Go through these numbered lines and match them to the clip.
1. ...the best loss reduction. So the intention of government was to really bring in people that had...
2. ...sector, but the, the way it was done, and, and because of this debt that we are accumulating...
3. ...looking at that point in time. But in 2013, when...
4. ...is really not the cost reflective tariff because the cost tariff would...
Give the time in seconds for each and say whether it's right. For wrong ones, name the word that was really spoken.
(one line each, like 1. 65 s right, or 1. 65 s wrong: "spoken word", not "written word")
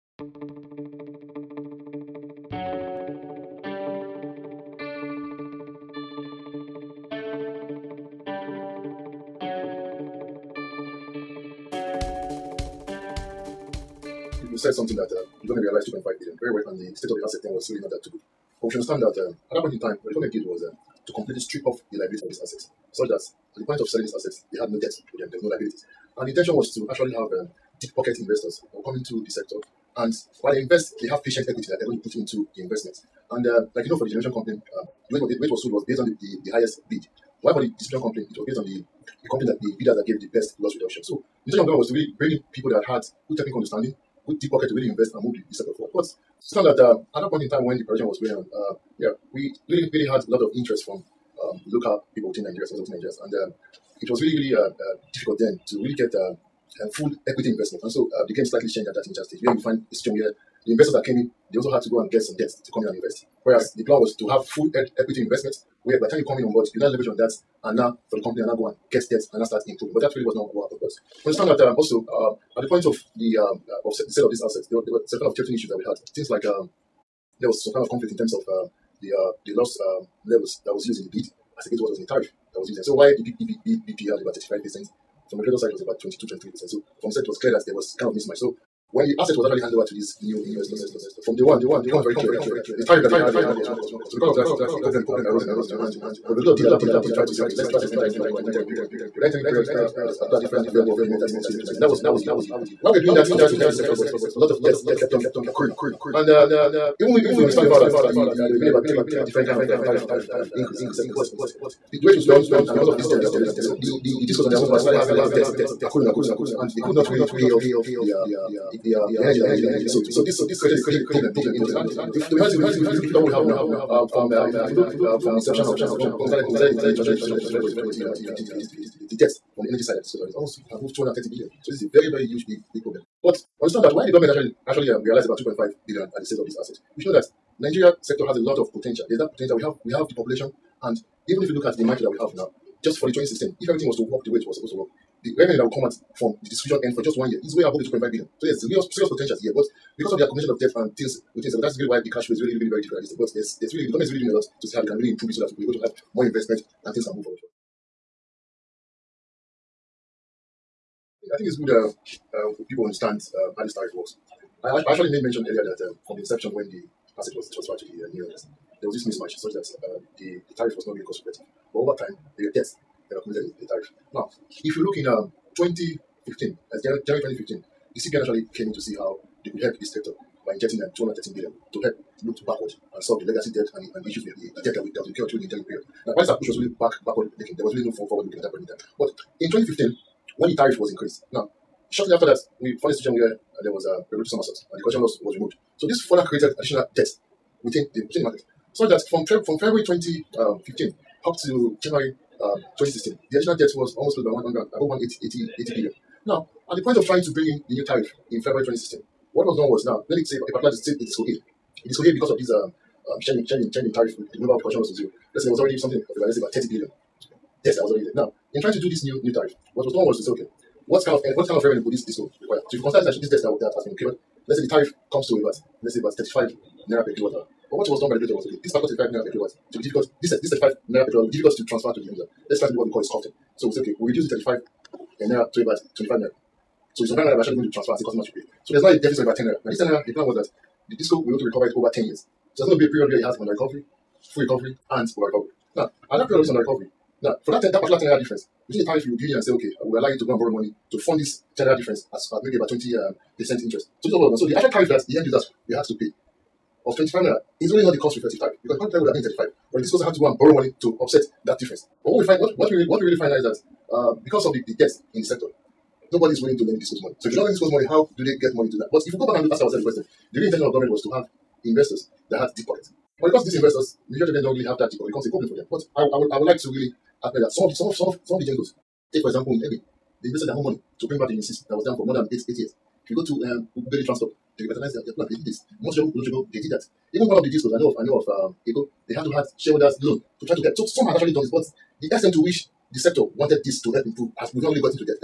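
1. 40 s right
2. 110 s right
3. 188 s wrong: "2015", not "2013"
4. 257 s right.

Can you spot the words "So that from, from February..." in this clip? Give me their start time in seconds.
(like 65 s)
198 s.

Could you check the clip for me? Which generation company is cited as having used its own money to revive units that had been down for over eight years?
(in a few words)
Egbin.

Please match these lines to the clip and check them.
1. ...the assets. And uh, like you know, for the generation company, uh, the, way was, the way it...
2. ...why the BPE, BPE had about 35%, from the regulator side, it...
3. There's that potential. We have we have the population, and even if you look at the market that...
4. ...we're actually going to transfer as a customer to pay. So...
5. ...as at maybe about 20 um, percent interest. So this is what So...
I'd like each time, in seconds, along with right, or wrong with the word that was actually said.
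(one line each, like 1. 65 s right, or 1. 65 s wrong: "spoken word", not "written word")
1. 32 s wrong: "investments", not "assets"
2. 82 s right
3. 139 s right
4. 237 s right
5. 252 s right.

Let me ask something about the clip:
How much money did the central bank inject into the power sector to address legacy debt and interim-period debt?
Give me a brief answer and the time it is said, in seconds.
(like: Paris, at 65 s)
213 billion, at 180 s.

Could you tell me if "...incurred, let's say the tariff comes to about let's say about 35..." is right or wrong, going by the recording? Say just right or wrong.
right.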